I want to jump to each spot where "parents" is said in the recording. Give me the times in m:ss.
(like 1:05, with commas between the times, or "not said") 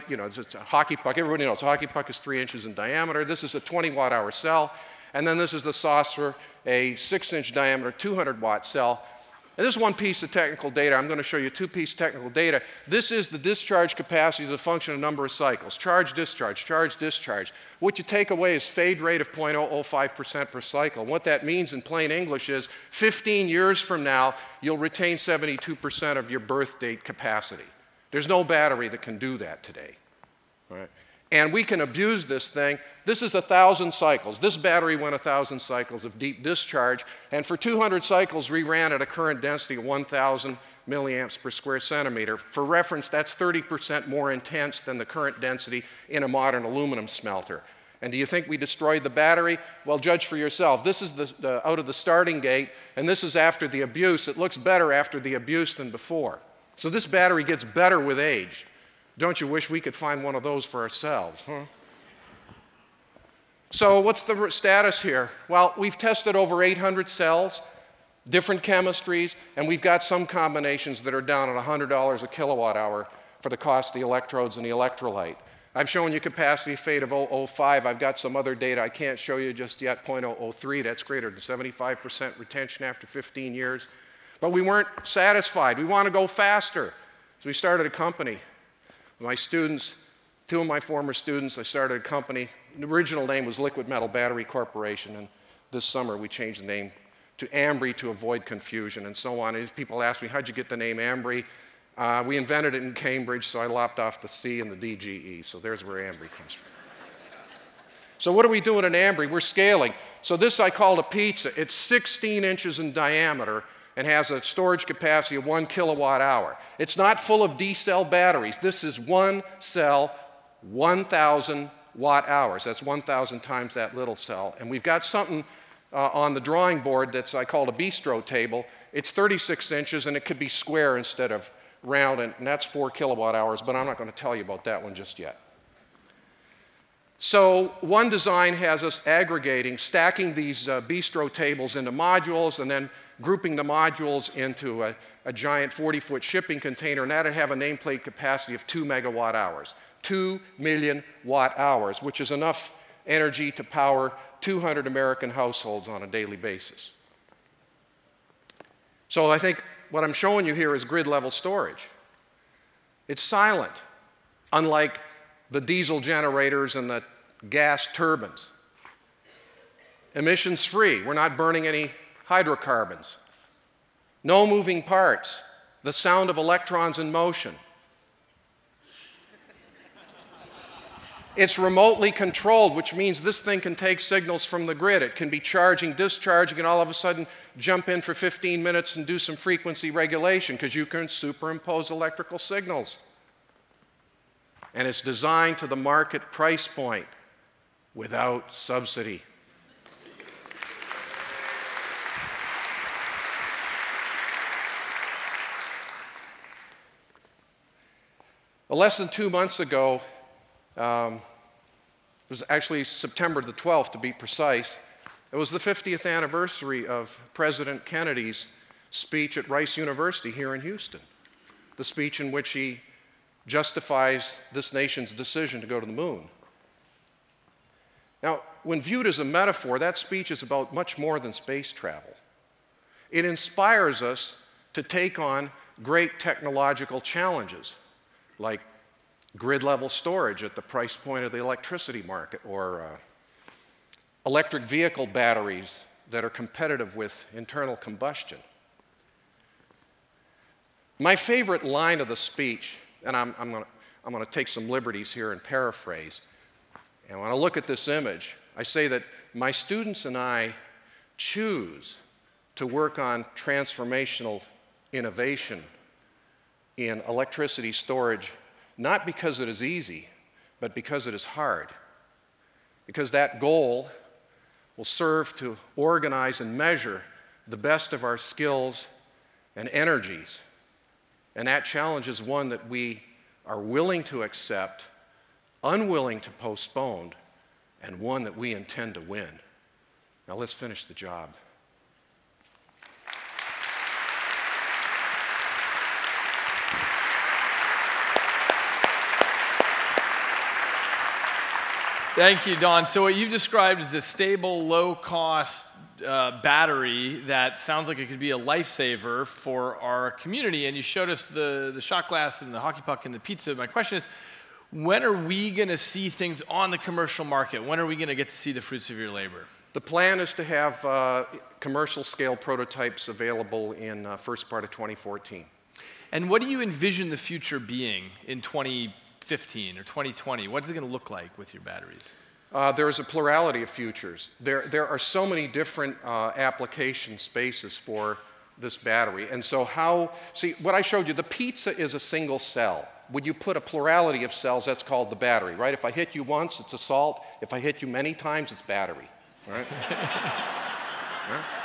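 not said.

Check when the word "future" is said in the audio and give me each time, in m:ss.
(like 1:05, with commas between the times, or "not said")
5:27, 5:33.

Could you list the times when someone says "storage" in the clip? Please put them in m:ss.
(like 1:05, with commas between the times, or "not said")
1:54, 2:41, 3:59, 4:27.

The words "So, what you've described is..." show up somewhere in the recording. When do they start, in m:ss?
5:02.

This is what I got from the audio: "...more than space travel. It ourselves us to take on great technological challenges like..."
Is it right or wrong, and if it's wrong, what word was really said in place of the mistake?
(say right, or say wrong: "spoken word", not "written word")
wrong: "inspires", not "ourselves".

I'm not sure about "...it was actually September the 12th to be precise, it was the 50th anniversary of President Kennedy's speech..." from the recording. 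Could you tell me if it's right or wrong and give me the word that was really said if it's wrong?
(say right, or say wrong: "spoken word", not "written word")
right.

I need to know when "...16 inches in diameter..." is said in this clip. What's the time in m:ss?
1:51.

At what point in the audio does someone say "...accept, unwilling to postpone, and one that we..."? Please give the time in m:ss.
4:44.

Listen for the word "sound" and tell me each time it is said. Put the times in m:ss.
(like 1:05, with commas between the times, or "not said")
2:55, 5:07.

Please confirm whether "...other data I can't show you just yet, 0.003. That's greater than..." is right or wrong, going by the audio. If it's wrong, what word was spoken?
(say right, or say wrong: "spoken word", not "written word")
right.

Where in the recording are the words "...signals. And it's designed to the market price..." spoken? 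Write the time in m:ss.
3:12.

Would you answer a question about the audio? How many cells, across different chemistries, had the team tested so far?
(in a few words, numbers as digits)
800.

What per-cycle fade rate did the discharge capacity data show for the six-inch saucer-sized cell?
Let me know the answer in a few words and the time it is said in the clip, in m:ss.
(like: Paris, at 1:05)
0.005%, at 0:19.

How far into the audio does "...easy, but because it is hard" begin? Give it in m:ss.
4:29.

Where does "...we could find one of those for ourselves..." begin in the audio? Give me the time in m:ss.
0:59.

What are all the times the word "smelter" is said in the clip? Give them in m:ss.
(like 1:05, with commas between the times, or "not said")
0:47.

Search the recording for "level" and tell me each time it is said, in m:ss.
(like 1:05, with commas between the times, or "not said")
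2:41, 3:59.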